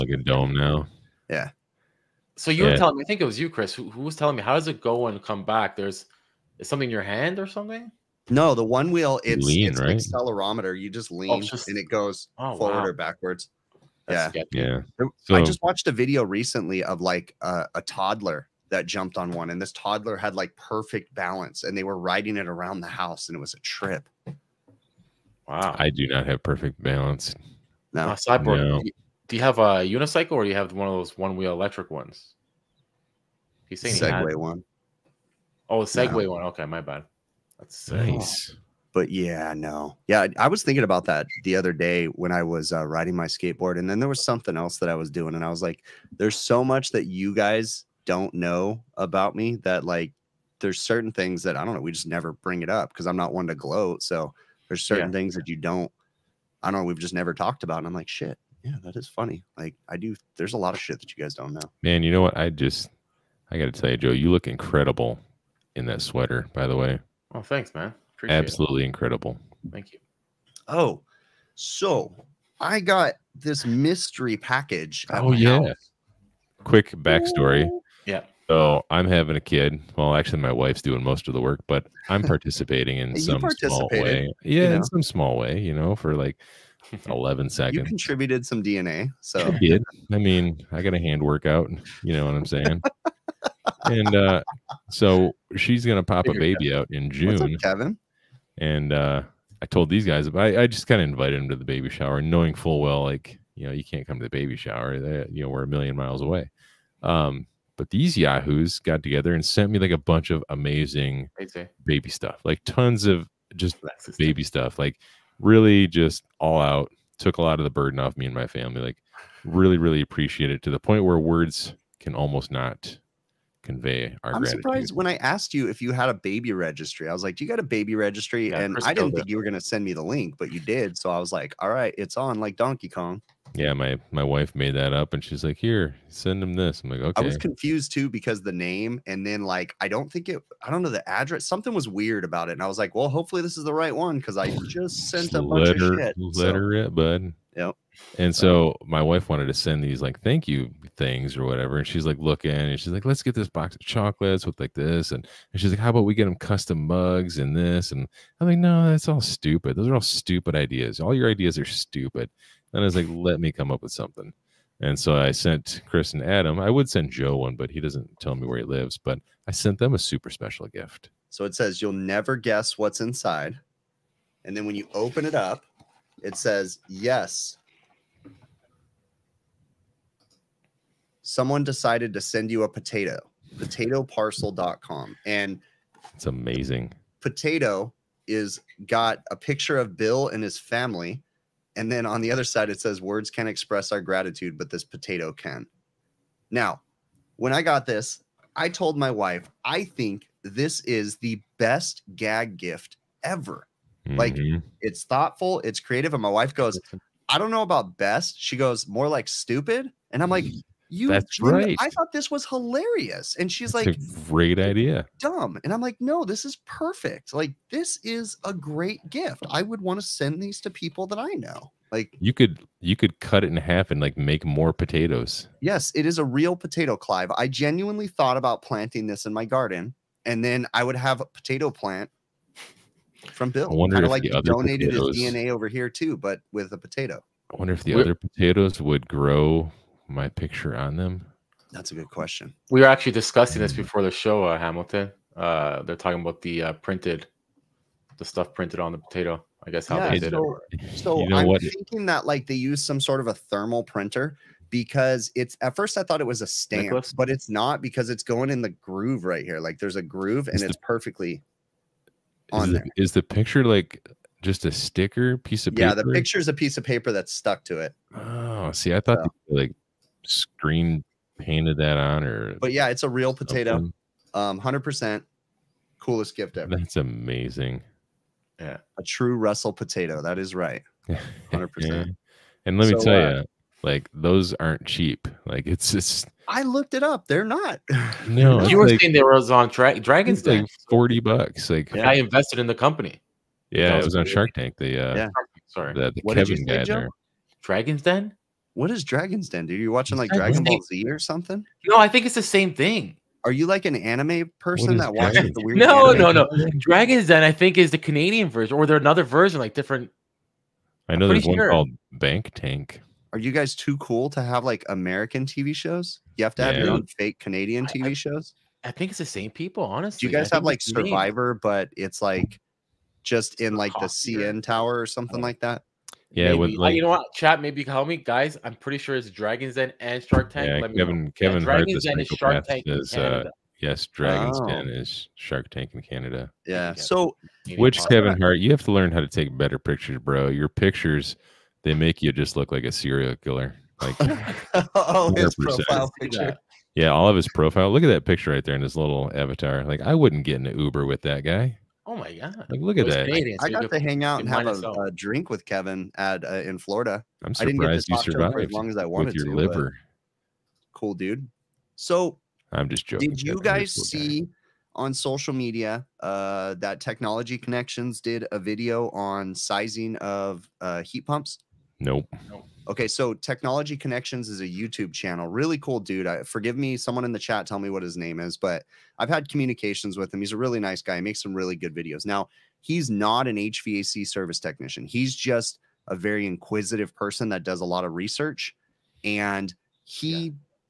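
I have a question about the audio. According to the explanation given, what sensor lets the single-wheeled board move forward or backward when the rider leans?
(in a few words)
accelerometer.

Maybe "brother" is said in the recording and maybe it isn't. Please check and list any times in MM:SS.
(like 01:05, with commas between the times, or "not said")
not said.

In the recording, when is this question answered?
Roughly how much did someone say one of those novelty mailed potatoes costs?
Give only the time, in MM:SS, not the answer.
04:50.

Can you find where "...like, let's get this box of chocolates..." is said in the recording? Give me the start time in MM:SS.
02:32.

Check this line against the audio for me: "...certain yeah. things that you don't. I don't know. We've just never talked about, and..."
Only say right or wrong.
right.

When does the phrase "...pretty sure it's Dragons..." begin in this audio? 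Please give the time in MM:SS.
05:28.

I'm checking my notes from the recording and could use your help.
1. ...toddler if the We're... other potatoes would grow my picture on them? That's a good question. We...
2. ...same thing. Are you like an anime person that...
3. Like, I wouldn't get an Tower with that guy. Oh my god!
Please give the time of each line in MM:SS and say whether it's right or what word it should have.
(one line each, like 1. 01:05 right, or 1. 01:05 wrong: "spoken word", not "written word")
1. 03:57 wrong: "wonder", not "toddler"
2. 05:02 right
3. 05:49 wrong: "Uber", not "Tower".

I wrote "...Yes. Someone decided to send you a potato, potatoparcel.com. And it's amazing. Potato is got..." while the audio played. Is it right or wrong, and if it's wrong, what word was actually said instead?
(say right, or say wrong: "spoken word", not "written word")
right.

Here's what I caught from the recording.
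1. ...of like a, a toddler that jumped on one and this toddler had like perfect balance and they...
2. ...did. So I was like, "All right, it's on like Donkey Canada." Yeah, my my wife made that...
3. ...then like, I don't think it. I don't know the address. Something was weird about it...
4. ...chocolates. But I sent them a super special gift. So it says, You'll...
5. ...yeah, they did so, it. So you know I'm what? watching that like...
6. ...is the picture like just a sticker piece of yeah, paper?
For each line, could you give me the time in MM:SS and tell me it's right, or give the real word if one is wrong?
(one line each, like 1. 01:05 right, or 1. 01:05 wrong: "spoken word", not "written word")
1. 00:16 right
2. 02:10 wrong: "Kong", not "Canada"
3. 02:19 right
4. 02:48 wrong: "lives", not "chocolates"
5. 04:09 wrong: "thinking", not "watching"
6. 04:23 right.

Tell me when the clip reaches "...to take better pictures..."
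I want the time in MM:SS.
05:39.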